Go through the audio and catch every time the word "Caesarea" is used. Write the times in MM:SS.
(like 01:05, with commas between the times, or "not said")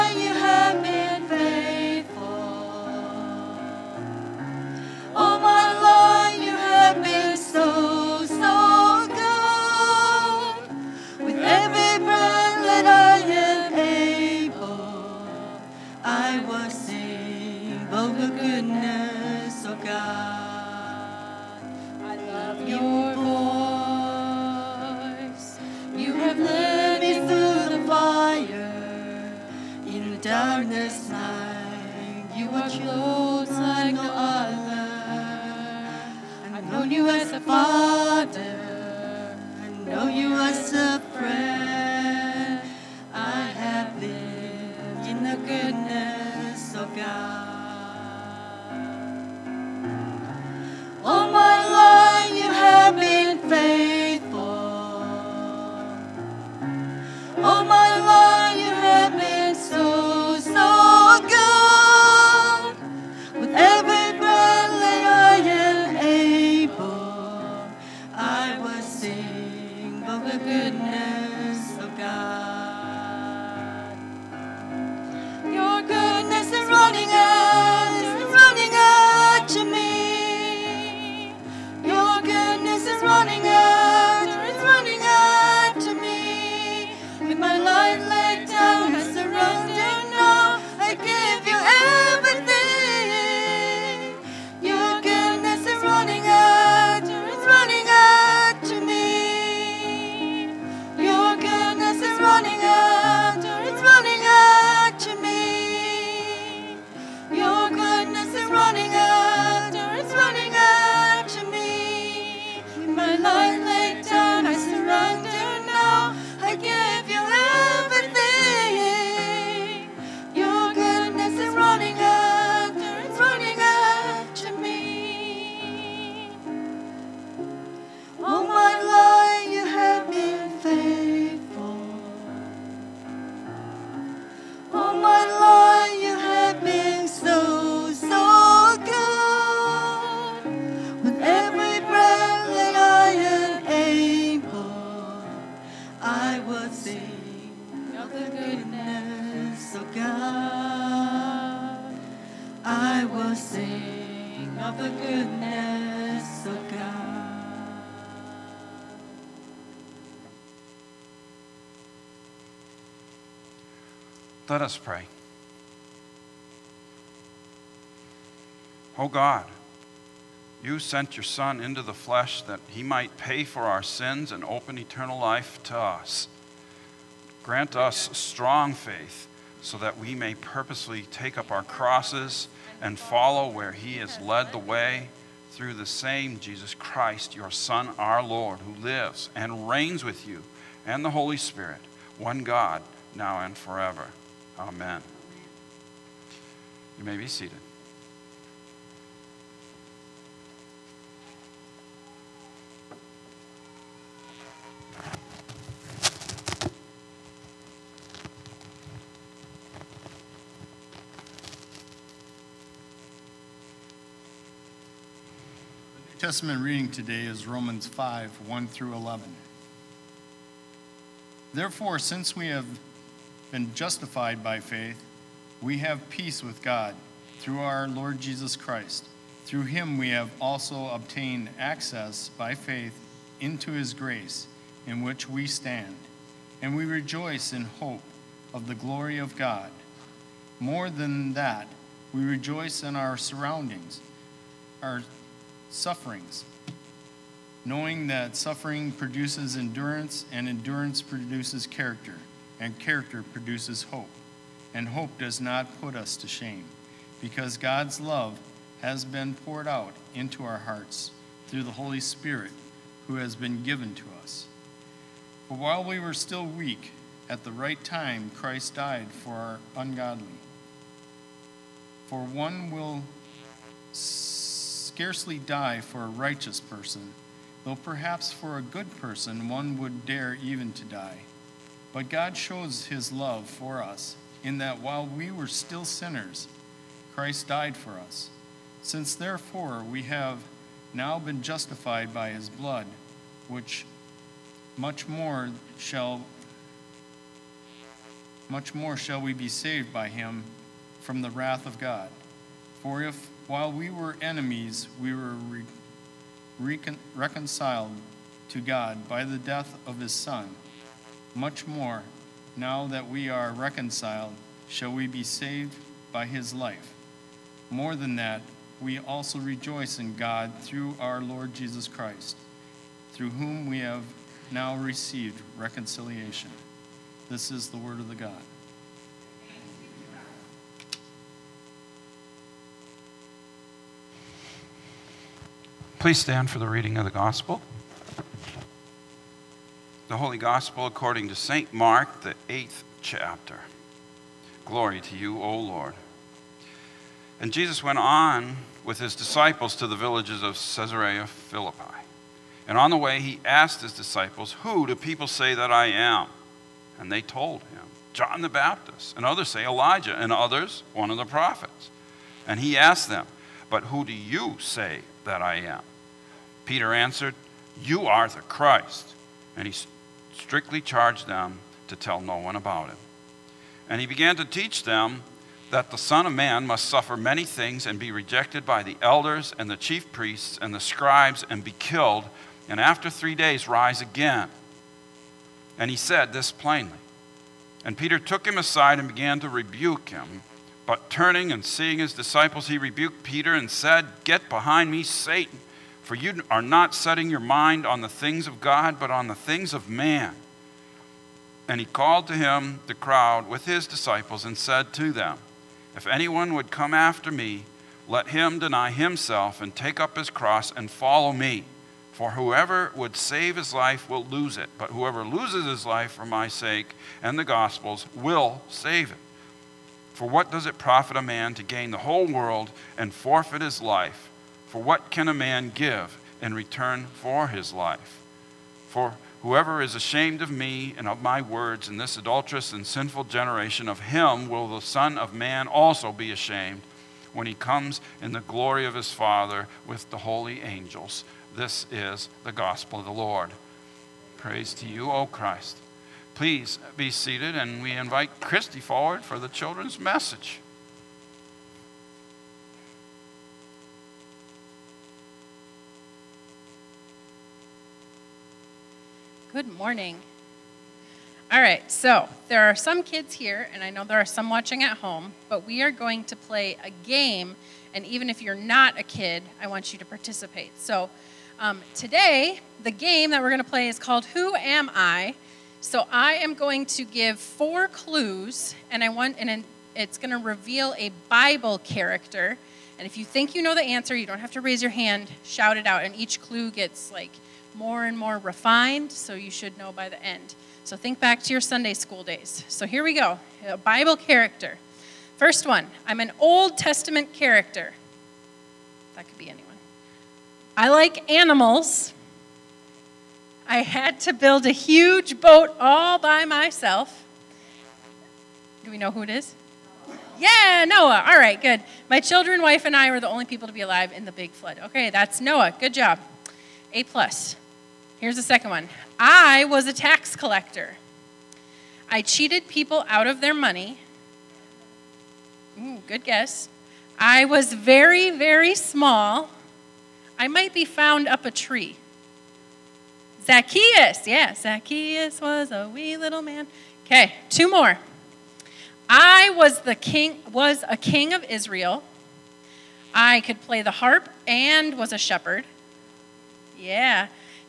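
05:50.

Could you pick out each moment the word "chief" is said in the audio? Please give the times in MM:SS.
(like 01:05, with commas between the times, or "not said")
06:19.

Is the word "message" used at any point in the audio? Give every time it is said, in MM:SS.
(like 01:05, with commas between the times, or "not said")
07:29.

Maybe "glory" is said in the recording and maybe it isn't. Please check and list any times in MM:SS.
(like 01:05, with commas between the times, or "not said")
03:58, 05:44, 07:18.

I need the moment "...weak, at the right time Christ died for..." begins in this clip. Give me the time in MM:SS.
04:26.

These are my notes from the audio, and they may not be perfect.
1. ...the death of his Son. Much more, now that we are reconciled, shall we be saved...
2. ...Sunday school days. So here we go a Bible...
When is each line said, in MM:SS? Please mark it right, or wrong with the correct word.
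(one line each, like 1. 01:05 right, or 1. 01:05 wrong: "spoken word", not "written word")
1. 05:09 right
2. 08:11 right.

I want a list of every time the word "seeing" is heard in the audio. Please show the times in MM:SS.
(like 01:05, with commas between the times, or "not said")
06:31.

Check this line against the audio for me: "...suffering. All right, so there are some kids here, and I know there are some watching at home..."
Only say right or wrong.
wrong.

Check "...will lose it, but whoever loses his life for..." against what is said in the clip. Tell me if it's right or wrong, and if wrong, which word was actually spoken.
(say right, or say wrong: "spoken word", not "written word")
right.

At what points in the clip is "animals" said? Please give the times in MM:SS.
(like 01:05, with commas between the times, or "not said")
08:21.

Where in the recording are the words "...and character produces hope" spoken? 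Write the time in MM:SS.
04:12.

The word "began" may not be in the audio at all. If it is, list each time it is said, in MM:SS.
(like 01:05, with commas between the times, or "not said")
06:14, 06:29.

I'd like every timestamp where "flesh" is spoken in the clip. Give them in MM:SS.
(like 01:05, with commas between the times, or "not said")
02:51.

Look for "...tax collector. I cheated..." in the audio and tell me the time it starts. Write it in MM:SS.
08:39.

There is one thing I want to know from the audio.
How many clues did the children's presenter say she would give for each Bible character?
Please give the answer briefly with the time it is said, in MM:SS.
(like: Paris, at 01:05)
4, at 07:57.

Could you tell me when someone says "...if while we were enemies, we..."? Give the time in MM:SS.
05:03.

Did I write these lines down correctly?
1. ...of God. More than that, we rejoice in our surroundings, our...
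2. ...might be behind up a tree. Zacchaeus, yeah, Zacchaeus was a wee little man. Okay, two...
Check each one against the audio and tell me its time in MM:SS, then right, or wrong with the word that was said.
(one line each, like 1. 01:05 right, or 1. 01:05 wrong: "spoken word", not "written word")
1. 03:59 right
2. 08:50 wrong: "found", not "behind".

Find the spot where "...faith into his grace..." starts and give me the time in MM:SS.
03:52.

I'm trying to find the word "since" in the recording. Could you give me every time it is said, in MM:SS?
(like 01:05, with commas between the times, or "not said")
03:41, 04:48.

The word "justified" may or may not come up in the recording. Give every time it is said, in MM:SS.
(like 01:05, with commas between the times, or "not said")
03:43, 04:51.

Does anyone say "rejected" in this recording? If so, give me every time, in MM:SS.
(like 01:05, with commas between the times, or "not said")
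06:18.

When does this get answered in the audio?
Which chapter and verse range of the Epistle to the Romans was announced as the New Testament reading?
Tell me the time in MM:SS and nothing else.
03:37.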